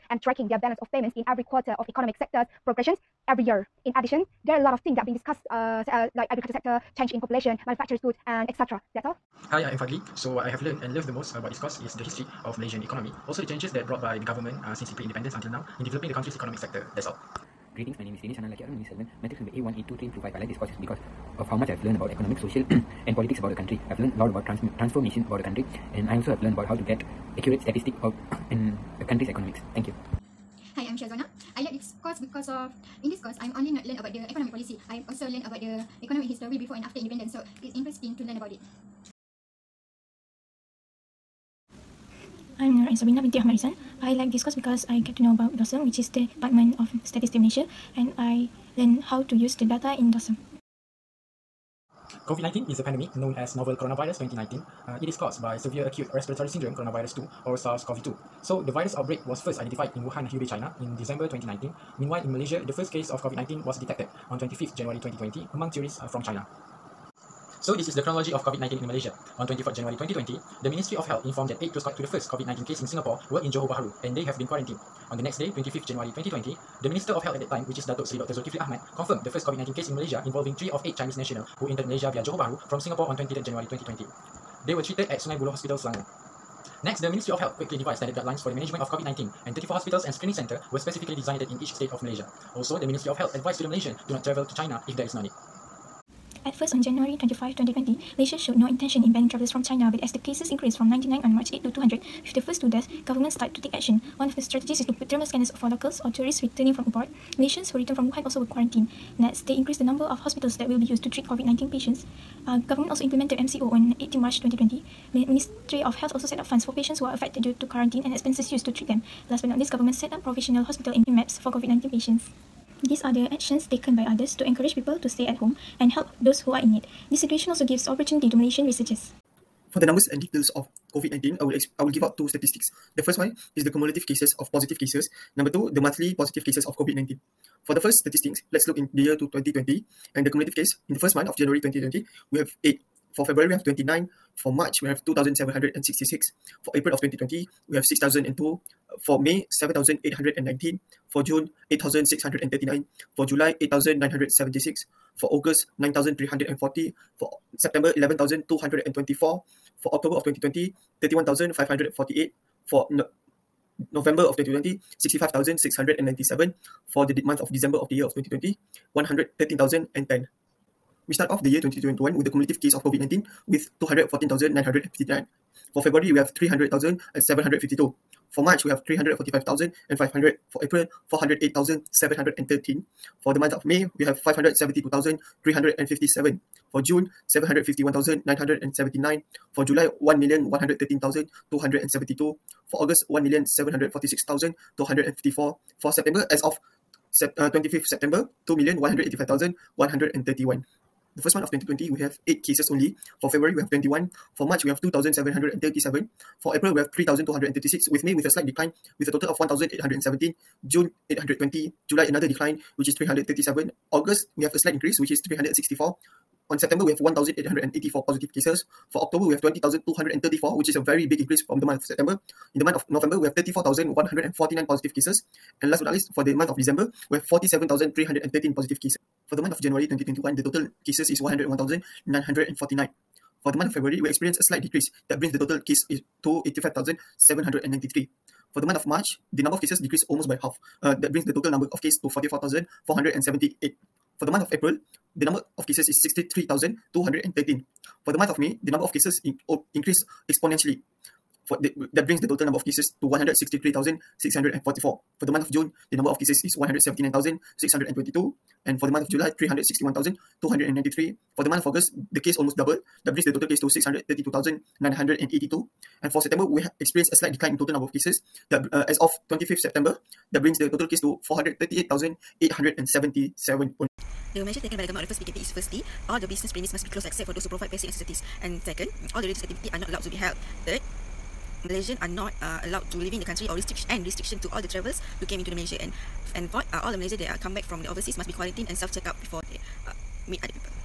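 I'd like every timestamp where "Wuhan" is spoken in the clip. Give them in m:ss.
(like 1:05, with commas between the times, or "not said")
1:00, 1:48.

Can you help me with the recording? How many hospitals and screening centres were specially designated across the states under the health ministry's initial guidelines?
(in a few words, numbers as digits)
34.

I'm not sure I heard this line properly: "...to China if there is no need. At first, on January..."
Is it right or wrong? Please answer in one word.
right.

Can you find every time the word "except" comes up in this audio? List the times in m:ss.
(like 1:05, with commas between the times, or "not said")
4:37.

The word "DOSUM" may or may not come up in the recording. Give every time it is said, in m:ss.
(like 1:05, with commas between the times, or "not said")
0:45.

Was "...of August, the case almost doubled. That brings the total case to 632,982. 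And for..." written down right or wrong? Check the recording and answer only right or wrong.
right.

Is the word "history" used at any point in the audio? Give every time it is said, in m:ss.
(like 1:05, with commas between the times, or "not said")
0:12, 0:36.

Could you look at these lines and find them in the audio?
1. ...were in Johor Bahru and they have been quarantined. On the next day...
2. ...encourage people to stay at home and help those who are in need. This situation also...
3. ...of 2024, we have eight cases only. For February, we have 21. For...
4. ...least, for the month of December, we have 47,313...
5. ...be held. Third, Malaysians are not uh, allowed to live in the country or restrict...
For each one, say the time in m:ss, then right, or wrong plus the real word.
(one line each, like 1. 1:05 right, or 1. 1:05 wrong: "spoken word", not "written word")
1. 1:13 right
2. 2:04 right
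3. 3:21 wrong: "2020", not "2024"
4. 3:45 right
5. 4:40 right.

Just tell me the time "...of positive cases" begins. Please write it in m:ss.
2:14.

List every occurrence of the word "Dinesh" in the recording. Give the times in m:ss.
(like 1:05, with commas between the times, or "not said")
0:18.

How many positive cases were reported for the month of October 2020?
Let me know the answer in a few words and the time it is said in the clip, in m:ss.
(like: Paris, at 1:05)
20,234, at 3:39.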